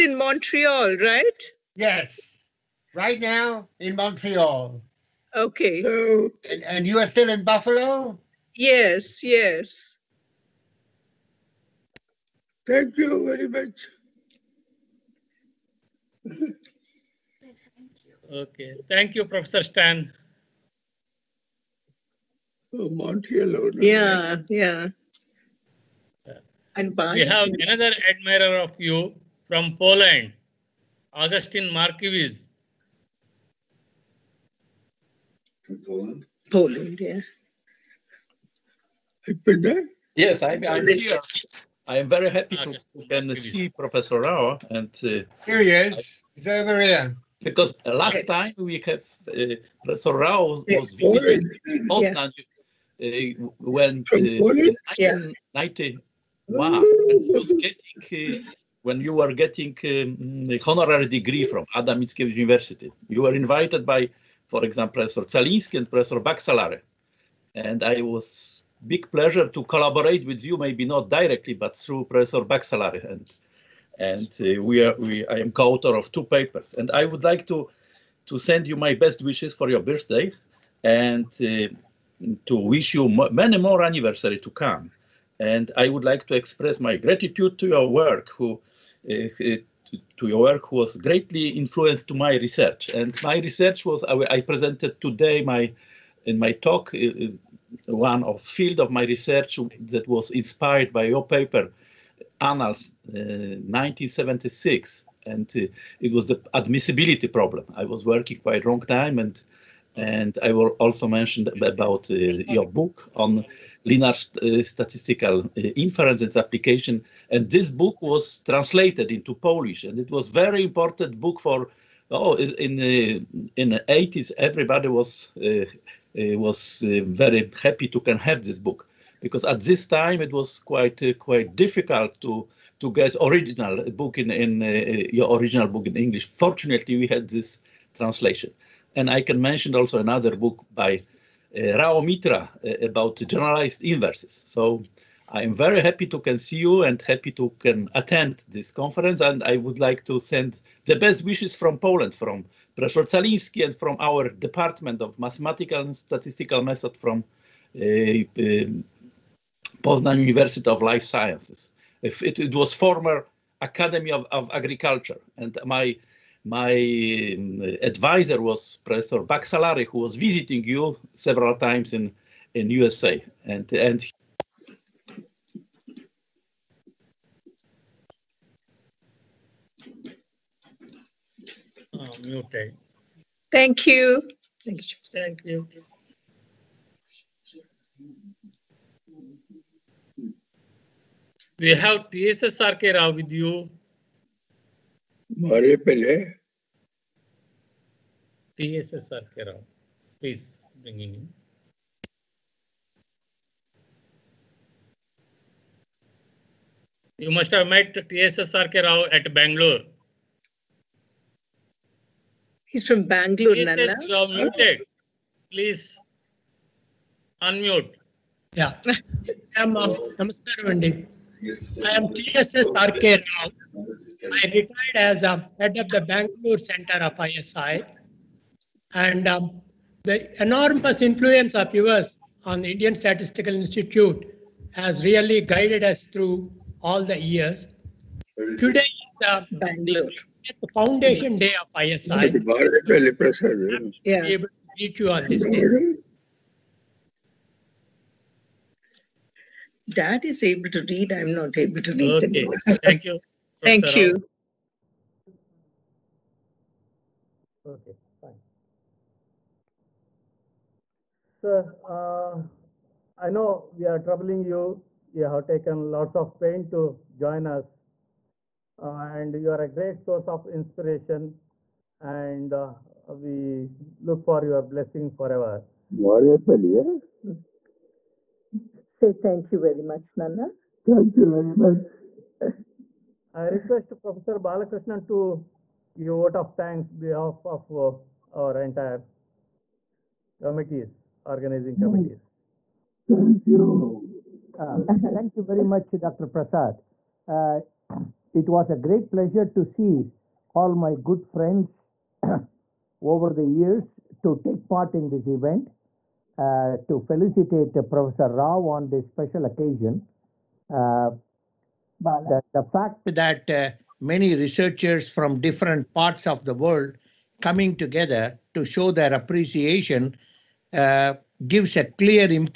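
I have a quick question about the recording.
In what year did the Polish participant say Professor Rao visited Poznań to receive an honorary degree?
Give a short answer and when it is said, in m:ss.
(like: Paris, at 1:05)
1991, at 0:55.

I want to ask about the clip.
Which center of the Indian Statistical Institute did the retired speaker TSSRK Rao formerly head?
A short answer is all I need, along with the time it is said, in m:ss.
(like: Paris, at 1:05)
Bangalore Center, at 3:46.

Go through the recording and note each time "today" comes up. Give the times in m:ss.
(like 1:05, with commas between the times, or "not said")
1:35, 3:58.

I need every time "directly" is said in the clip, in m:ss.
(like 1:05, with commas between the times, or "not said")
1:11.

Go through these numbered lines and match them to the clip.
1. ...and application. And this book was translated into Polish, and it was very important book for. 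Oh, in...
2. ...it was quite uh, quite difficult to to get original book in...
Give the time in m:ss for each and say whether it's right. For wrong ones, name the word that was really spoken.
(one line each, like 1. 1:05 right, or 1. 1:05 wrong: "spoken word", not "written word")
1. 1:56 right
2. 2:10 right.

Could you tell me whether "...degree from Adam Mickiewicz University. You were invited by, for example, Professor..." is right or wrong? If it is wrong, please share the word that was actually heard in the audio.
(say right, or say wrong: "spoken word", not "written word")
right.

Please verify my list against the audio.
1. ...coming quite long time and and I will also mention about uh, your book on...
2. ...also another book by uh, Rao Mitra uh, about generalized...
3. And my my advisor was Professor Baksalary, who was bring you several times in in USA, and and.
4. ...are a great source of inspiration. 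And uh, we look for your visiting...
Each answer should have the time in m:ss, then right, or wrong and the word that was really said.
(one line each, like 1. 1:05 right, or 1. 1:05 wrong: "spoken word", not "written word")
1. 1:48 wrong: "working", not "coming"
2. 2:19 right
3. 2:45 wrong: "visiting", not "bring"
4. 4:29 wrong: "blessing", not "visiting".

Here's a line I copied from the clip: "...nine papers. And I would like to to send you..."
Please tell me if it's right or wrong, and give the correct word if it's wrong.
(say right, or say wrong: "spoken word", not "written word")
wrong: "two", not "nine".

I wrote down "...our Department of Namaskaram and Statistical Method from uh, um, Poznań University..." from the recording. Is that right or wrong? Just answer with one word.
wrong.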